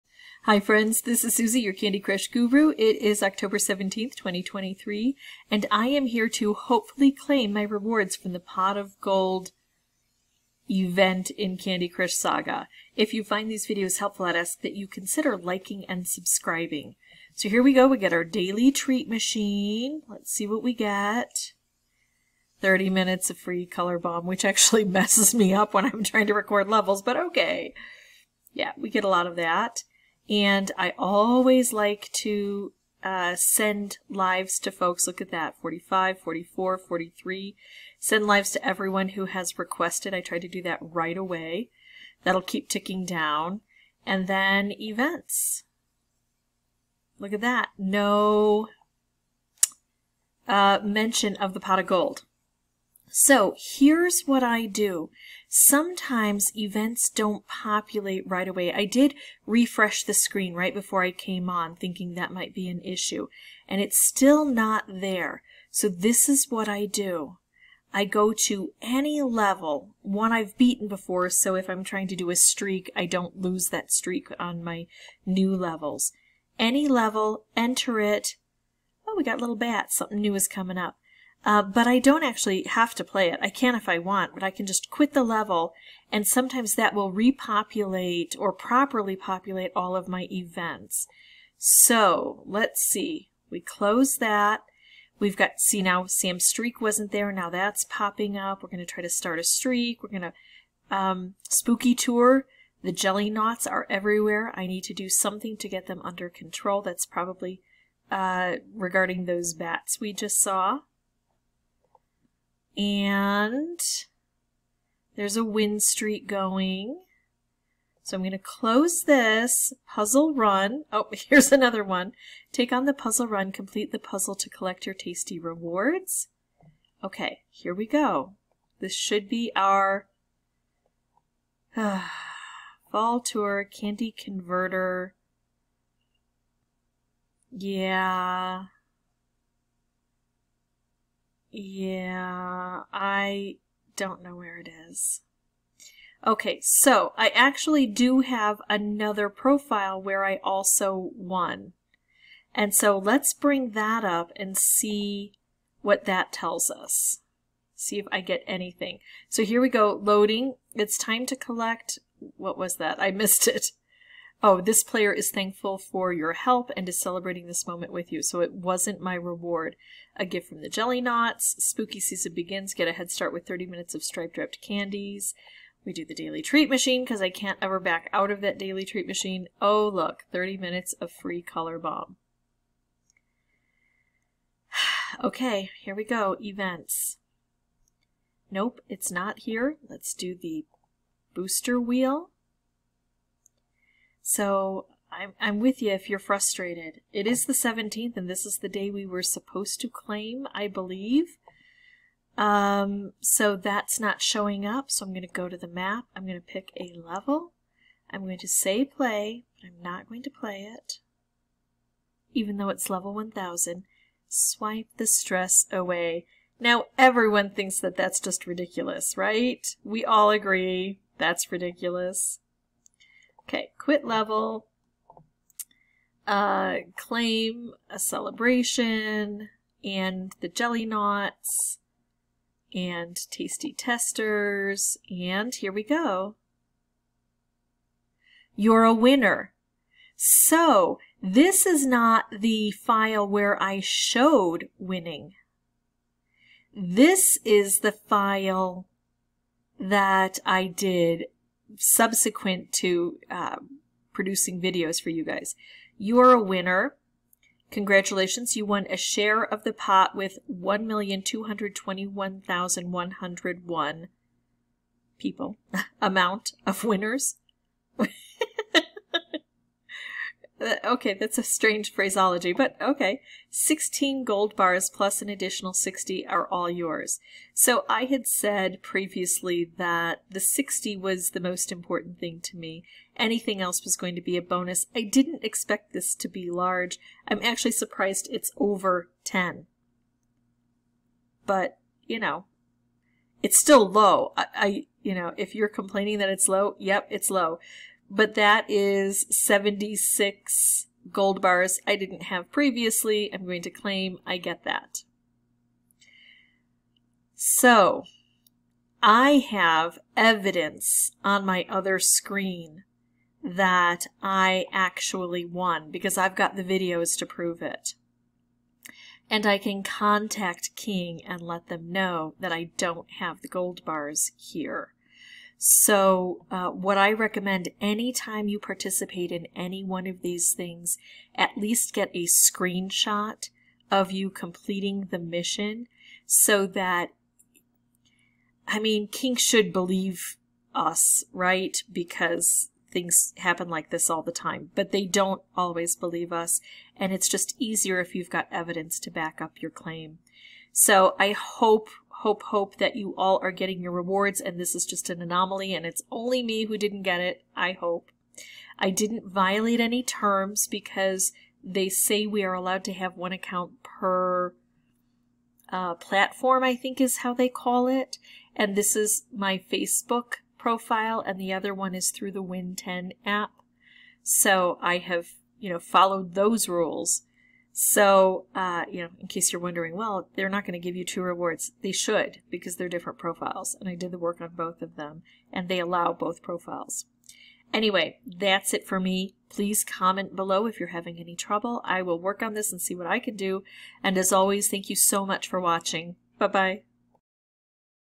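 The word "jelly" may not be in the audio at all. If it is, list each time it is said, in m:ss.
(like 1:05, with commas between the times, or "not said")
1:42, 2:50, 3:50.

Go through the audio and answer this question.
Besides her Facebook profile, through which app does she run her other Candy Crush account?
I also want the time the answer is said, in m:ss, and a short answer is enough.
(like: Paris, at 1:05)
Win10 app, at 6:12.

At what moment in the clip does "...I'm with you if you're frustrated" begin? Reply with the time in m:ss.
3:15.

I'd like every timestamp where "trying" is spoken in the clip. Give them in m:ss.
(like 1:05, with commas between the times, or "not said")
0:26, 1:11.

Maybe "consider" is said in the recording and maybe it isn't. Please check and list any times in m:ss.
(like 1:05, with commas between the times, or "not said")
0:14.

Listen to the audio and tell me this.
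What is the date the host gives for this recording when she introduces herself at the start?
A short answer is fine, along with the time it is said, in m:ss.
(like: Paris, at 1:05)
October 17th, 2023, at 0:03.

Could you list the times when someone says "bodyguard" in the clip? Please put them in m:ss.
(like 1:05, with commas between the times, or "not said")
not said.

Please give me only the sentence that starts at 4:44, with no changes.
I didn't expect this to be large.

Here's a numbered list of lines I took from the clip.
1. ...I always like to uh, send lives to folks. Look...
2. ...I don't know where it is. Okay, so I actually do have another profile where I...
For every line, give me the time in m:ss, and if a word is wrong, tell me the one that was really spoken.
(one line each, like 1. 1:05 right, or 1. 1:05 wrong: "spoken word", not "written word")
1. 0:30 right
2. 2:22 right.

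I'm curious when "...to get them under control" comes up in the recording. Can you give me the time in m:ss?
1:45.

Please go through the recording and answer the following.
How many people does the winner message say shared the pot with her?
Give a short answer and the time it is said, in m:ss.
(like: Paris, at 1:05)
1,221,101, at 4:20.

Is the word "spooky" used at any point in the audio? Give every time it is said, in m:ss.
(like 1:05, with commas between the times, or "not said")
1:41, 2:51.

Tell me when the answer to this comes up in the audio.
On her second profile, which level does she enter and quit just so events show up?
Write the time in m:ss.
3:32.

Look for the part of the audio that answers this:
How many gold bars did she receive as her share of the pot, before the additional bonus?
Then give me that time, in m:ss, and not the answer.
4:33.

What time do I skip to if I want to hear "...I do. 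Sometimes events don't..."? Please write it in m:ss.
0:54.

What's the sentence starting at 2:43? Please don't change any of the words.
I missed it oh, this player is thankful for your help and is celebrating this moment with you.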